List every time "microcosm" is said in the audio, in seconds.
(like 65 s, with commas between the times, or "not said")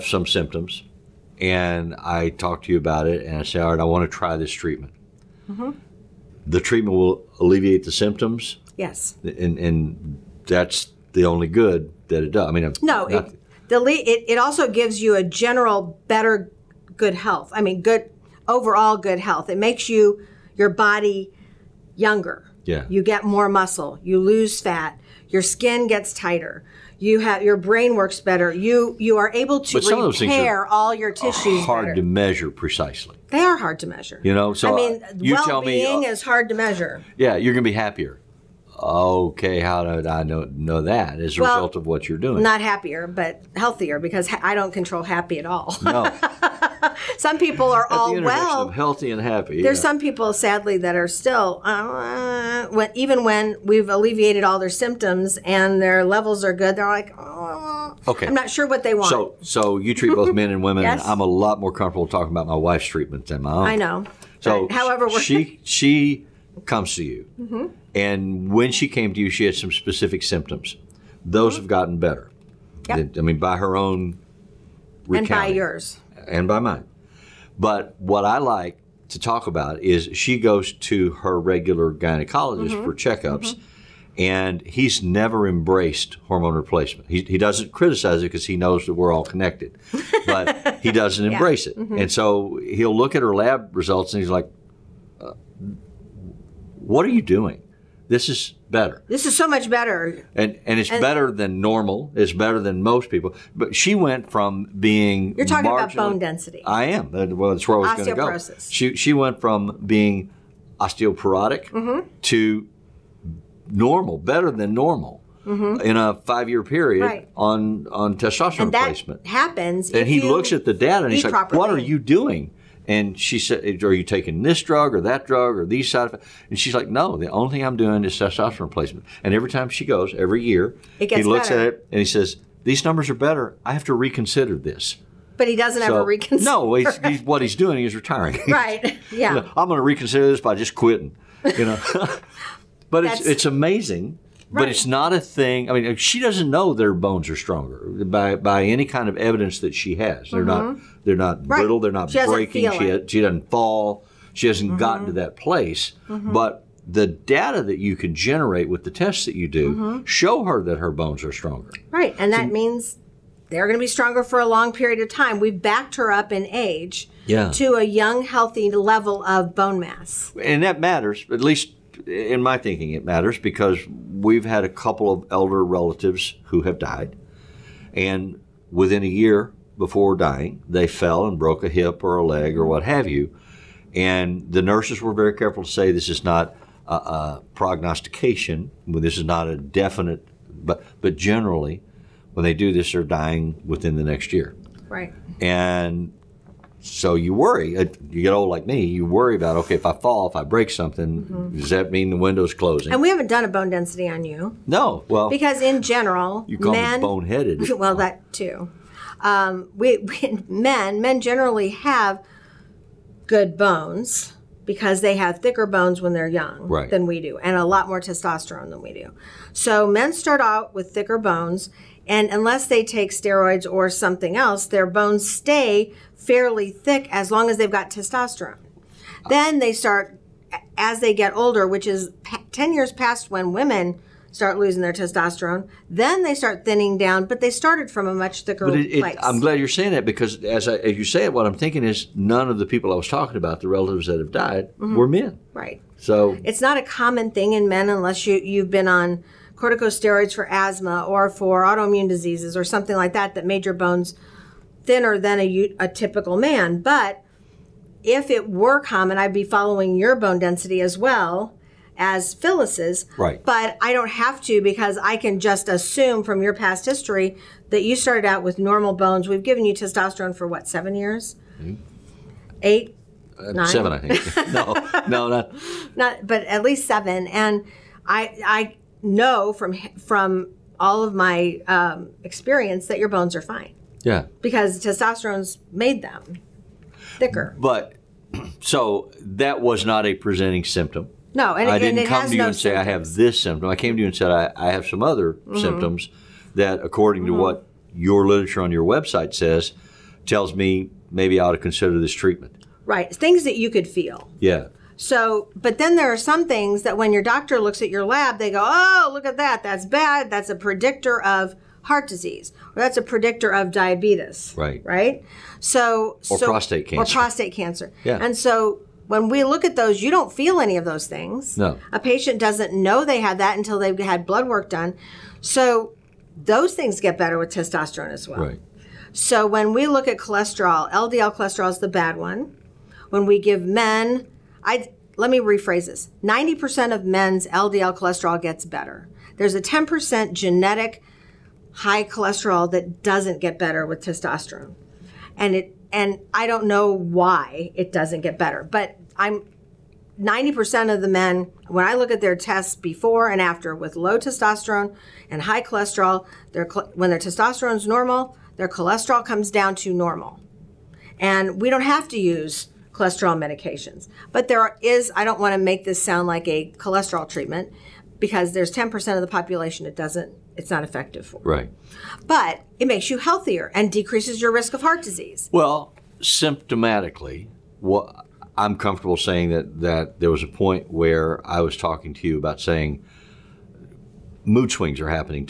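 not said.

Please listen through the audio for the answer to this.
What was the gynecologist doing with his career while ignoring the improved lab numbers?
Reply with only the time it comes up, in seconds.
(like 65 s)
137 s.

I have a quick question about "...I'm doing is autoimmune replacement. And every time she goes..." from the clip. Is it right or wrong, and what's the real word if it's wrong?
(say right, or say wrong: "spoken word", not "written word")
wrong: "testosterone", not "autoimmune".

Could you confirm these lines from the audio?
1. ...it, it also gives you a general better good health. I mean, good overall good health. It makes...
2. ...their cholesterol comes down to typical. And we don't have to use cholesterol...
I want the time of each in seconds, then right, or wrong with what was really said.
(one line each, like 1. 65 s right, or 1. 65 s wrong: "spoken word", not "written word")
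1. 13 s right
2. 358 s wrong: "normal", not "typical".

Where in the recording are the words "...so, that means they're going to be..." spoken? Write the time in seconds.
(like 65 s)
162 s.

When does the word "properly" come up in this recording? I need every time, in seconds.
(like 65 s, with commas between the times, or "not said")
121 s.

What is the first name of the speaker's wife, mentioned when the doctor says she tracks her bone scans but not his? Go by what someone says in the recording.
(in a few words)
Phyllis.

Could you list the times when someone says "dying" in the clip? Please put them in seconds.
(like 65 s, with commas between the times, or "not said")
180 s, 193 s.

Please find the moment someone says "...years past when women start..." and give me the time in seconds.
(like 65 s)
232 s.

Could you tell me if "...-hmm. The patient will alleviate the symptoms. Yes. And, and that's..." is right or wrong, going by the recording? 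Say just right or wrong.
wrong.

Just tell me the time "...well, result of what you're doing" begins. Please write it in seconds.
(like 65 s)
41 s.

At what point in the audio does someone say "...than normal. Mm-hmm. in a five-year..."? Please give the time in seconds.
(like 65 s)
114 s.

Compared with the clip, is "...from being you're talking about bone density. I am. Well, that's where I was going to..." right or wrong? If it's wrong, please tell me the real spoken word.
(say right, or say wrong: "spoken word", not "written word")
right.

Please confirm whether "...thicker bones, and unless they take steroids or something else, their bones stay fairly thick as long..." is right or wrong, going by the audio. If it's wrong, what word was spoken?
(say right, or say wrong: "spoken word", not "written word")
right.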